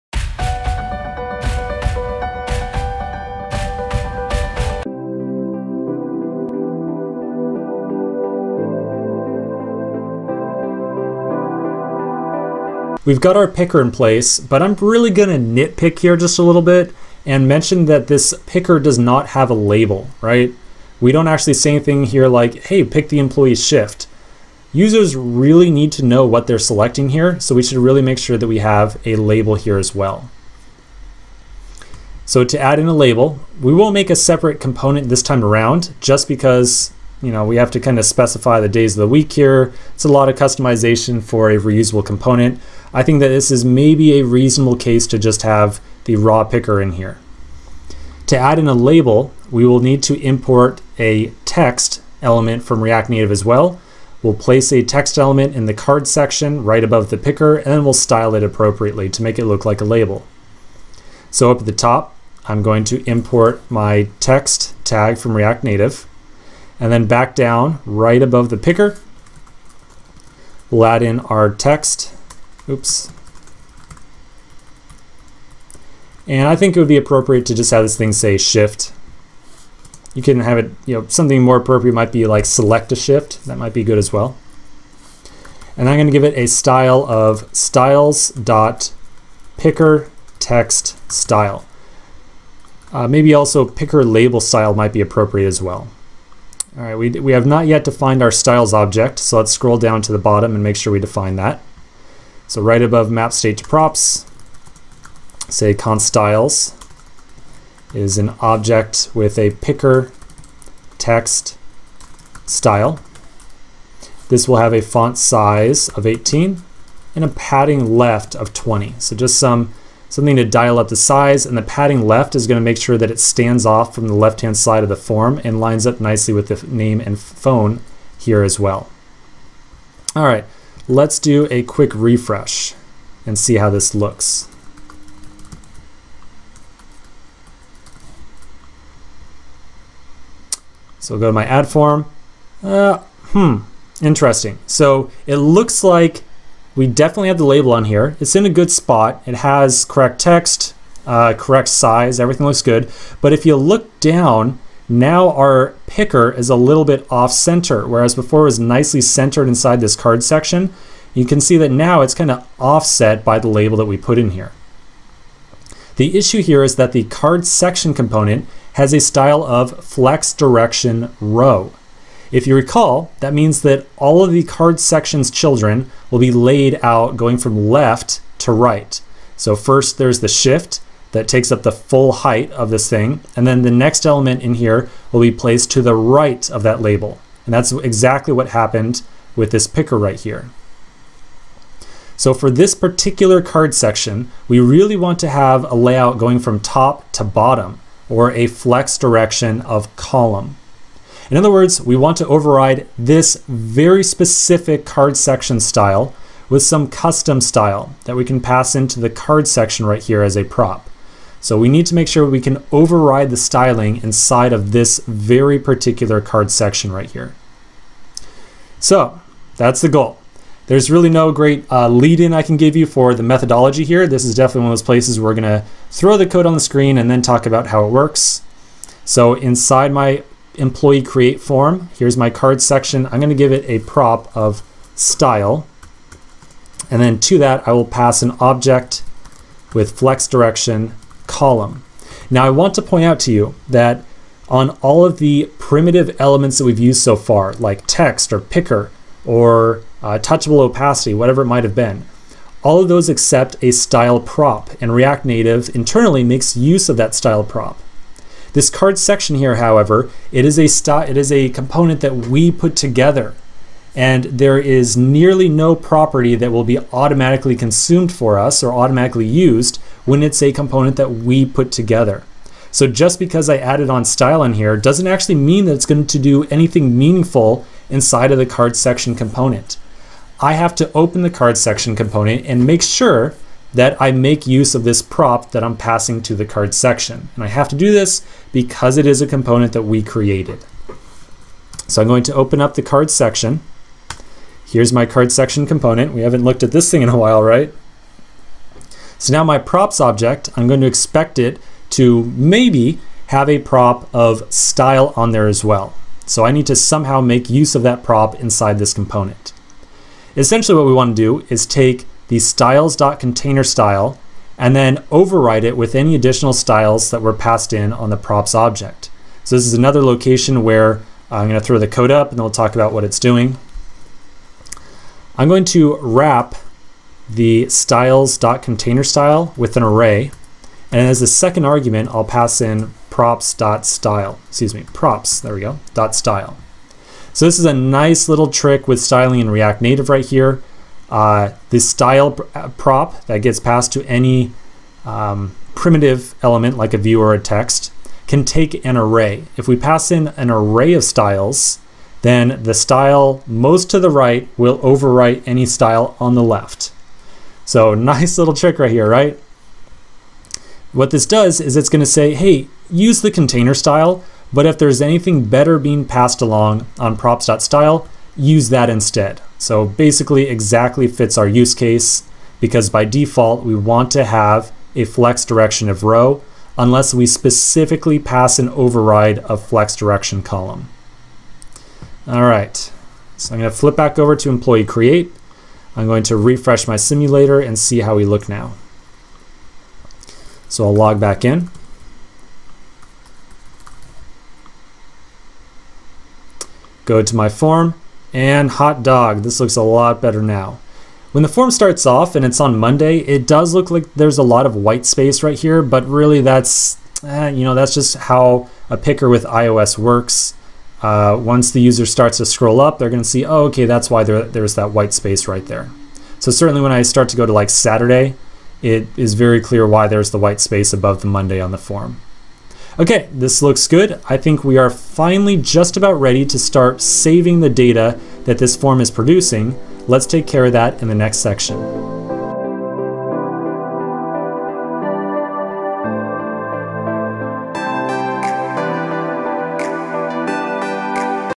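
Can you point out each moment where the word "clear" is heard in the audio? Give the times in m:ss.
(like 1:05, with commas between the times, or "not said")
6:59.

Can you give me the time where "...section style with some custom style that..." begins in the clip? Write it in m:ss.
3:25.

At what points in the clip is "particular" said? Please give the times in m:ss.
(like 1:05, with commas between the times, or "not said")
3:12, 3:35.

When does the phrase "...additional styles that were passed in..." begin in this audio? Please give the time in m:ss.
5:16.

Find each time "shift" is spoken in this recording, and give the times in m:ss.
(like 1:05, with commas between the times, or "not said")
0:23, 1:18, 1:22, 3:00.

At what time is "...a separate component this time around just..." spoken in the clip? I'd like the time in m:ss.
0:34.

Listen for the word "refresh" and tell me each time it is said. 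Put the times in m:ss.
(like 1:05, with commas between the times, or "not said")
2:11, 6:26.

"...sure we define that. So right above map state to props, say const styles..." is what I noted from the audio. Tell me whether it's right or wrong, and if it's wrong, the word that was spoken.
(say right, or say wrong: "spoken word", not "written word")
right.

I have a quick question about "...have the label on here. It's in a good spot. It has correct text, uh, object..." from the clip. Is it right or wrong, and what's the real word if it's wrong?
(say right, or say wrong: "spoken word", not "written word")
wrong: "correct", not "object".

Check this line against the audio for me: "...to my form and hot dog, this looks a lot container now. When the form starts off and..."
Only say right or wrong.
wrong.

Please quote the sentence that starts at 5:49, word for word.
If we pass in an array of styles, then the style most to the right will overwrite any style on the left.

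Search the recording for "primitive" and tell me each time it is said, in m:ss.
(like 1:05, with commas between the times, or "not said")
4:05, 5:45.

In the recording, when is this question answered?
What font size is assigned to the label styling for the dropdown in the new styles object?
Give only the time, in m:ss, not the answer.
1:56.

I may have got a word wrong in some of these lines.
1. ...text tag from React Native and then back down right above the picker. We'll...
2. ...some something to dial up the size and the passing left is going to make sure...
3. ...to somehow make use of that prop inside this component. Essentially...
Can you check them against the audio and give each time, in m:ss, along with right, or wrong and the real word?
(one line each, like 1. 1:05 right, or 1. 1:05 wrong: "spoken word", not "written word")
1. 1:04 right
2. 1:59 wrong: "padding", not "passing"
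3. 5:06 right.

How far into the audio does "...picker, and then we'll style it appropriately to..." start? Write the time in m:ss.
0:57.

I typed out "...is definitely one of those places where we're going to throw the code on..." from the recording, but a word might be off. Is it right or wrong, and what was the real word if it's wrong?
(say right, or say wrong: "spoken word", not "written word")
right.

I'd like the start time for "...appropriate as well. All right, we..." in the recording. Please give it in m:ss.
1:35.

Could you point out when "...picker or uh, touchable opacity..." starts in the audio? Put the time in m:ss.
4:08.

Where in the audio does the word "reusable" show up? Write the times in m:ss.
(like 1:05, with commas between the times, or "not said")
0:41.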